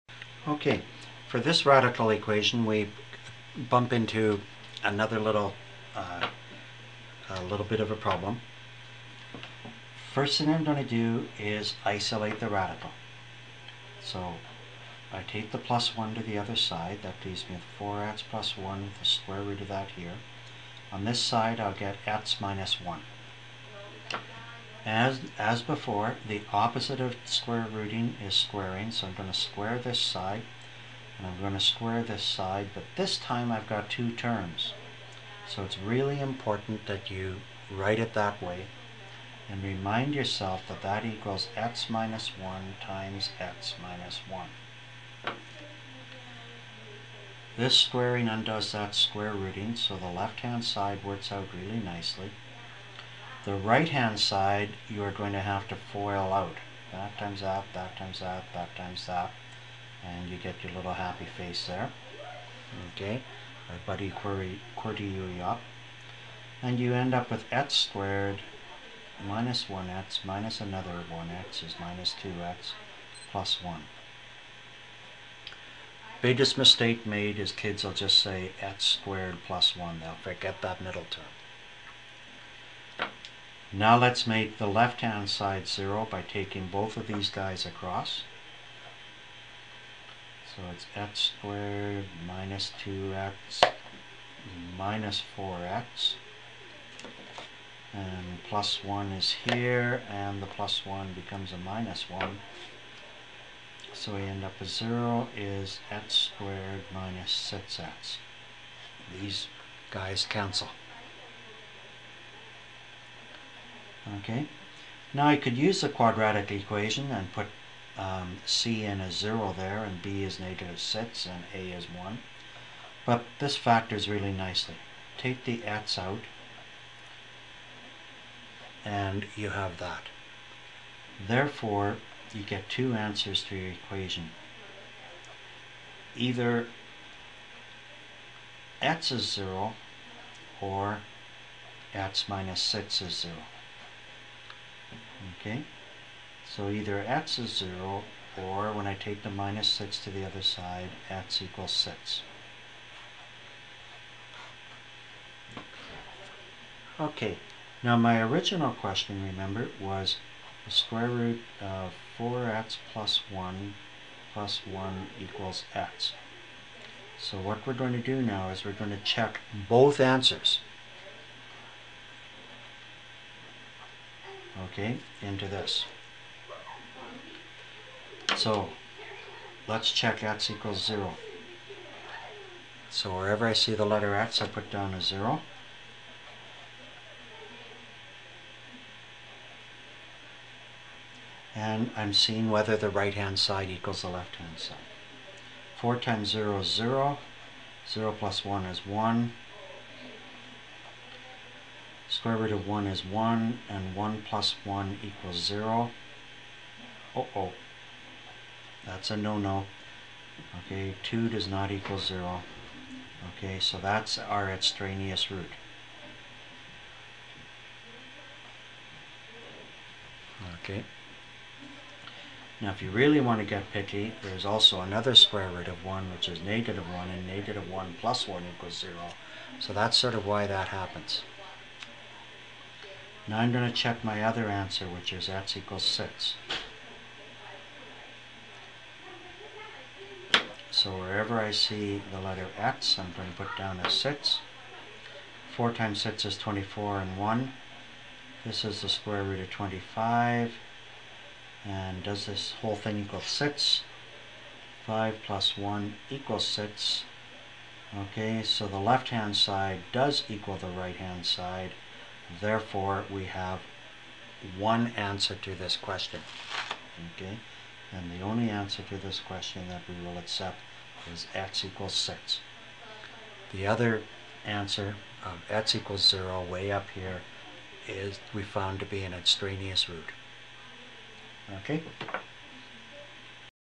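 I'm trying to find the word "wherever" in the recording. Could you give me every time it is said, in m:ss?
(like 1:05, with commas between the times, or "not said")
3:03, 4:00.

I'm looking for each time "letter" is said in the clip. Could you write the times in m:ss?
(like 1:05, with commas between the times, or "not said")
3:03, 4:02.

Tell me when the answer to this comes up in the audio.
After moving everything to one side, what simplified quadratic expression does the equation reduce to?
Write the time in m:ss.
1:45.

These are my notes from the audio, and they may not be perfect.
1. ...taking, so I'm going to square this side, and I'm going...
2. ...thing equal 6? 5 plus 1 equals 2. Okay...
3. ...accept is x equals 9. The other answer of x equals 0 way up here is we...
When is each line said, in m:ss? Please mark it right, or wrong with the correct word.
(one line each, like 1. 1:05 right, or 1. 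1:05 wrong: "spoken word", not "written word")
1. 0:28 wrong: "squaring", not "taking"
2. 4:12 wrong: "6", not "2"
3. 4:30 wrong: "6", not "9".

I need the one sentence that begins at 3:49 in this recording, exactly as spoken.
So that's sort of why that happens.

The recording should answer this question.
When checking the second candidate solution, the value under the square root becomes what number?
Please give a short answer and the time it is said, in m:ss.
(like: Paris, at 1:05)
25, at 4:09.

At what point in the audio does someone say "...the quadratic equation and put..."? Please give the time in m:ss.
1:55.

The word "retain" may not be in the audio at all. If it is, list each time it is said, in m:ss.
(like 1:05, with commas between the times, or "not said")
not said.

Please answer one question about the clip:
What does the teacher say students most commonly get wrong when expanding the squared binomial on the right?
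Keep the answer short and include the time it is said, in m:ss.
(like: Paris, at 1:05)
x squared plus 1, at 1:18.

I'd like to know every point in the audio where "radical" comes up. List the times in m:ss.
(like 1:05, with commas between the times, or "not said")
0:01, 0:12.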